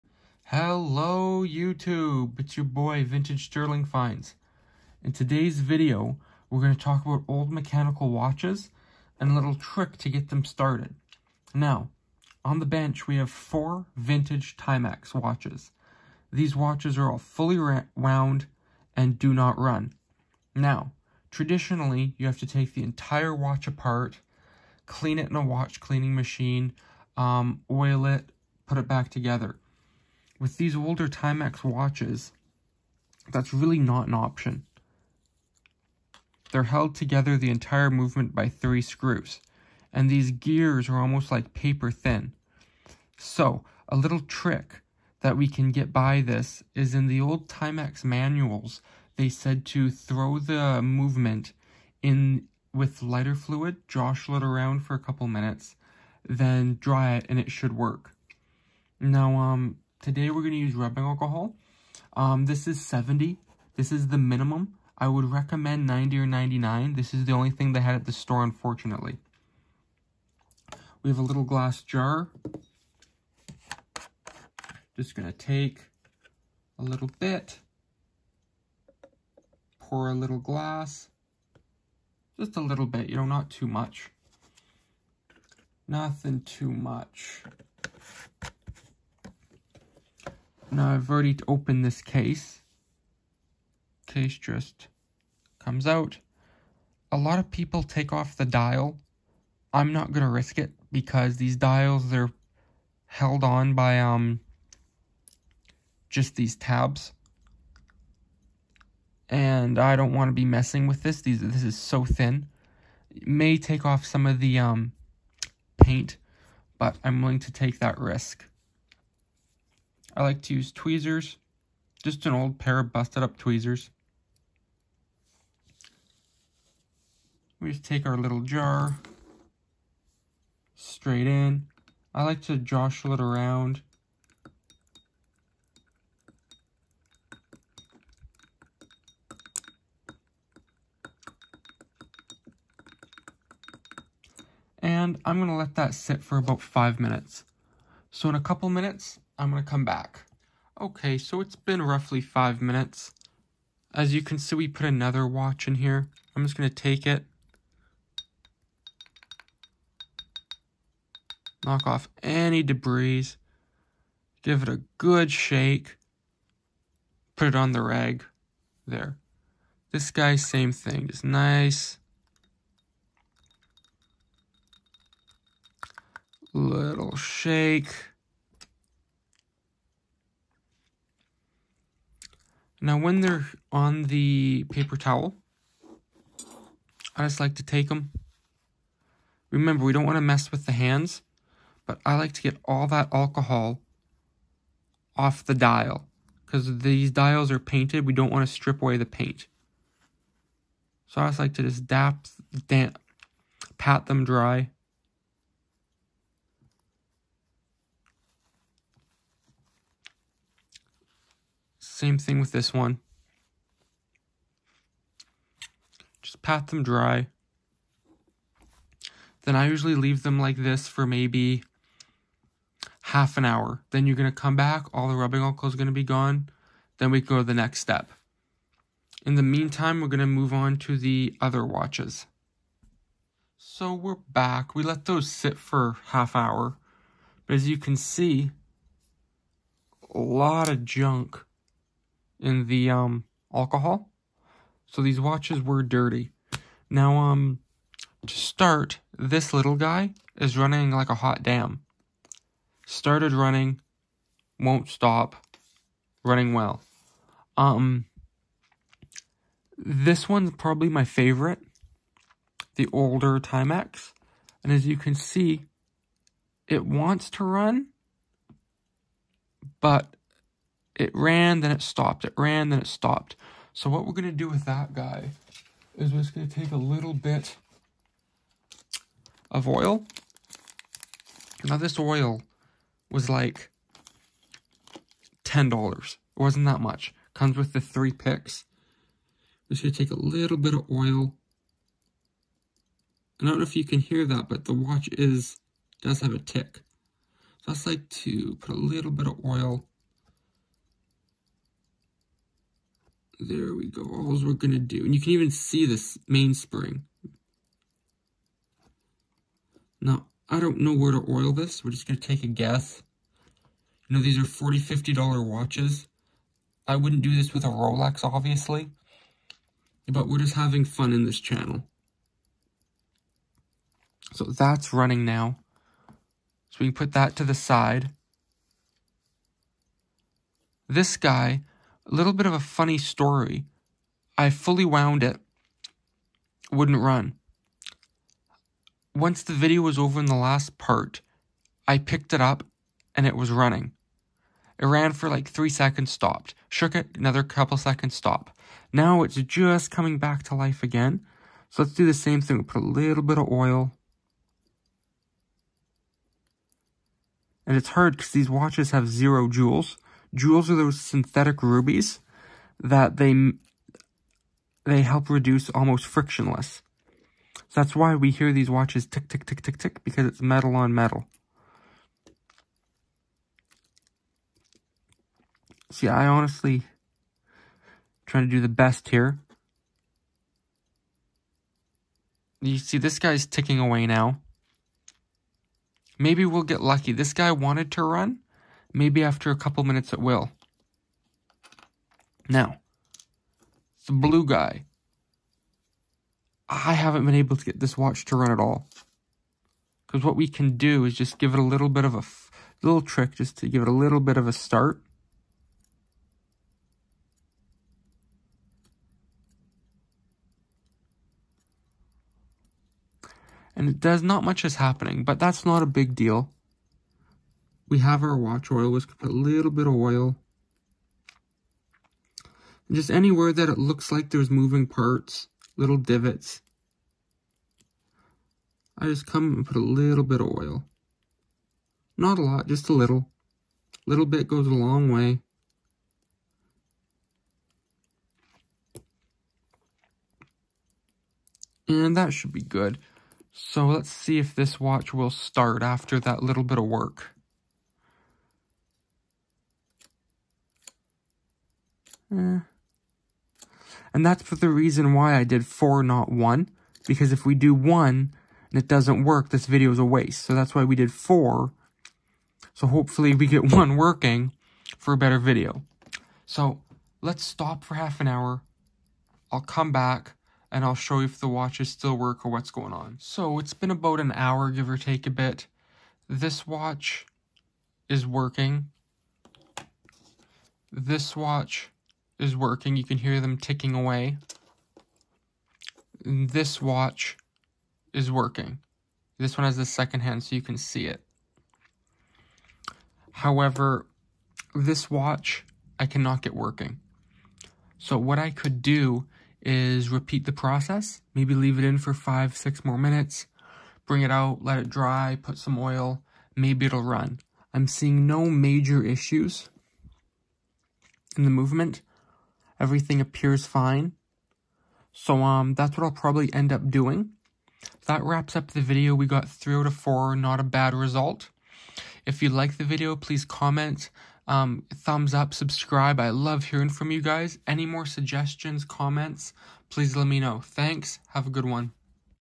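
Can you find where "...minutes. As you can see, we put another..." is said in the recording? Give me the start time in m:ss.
2:32.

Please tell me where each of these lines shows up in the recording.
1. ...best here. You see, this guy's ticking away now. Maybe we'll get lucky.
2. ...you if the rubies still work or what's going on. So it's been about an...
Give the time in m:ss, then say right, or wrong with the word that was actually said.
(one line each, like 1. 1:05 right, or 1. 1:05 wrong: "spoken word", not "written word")
1. 6:18 right
2. 7:51 wrong: "watches", not "rubies".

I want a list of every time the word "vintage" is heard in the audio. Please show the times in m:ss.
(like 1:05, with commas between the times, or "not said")
0:03, 0:13.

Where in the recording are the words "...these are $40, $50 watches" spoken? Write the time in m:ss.
5:14.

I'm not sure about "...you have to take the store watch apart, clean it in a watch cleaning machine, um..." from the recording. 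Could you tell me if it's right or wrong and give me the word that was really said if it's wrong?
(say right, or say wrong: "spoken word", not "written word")
wrong: "entire", not "store".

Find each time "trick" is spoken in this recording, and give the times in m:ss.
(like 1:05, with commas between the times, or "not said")
0:09, 0:44, 6:43.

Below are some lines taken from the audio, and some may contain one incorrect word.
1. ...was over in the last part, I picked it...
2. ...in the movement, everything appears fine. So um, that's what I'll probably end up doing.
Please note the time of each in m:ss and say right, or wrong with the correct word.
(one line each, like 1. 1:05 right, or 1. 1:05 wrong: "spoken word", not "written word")
1. 5:39 right
2. 8:31 right.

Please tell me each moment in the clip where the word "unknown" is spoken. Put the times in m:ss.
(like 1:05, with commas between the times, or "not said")
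not said.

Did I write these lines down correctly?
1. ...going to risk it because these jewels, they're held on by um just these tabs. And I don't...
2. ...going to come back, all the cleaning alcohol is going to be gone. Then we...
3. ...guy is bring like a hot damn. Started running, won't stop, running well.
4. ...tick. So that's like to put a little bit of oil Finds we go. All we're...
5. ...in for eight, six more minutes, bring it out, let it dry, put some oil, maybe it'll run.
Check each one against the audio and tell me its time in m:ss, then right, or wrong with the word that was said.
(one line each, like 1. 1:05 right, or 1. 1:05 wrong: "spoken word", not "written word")
1. 1:40 wrong: "dials", not "jewels"
2. 3:44 wrong: "rubbing", not "cleaning"
3. 4:09 wrong: "running", not "bring"
4. 4:56 wrong: "There", not "Finds"
5. 8:21 wrong: "five", not "eight".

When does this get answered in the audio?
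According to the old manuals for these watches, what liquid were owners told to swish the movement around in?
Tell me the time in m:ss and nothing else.
0:53.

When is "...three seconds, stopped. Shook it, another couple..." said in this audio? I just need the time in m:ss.
5:45.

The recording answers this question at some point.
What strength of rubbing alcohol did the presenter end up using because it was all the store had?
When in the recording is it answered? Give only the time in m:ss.
1:02.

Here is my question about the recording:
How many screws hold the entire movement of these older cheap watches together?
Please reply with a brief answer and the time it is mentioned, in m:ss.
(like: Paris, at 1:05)
3, at 0:38.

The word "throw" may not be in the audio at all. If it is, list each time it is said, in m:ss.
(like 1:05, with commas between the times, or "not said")
0:49.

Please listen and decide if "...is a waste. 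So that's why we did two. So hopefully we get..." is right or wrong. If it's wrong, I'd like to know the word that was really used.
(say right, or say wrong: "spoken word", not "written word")
wrong: "four", not "two".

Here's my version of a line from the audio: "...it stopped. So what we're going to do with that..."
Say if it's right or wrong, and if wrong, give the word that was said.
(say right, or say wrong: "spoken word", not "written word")
right.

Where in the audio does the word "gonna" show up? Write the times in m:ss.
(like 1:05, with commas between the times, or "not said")
2:29, 2:36.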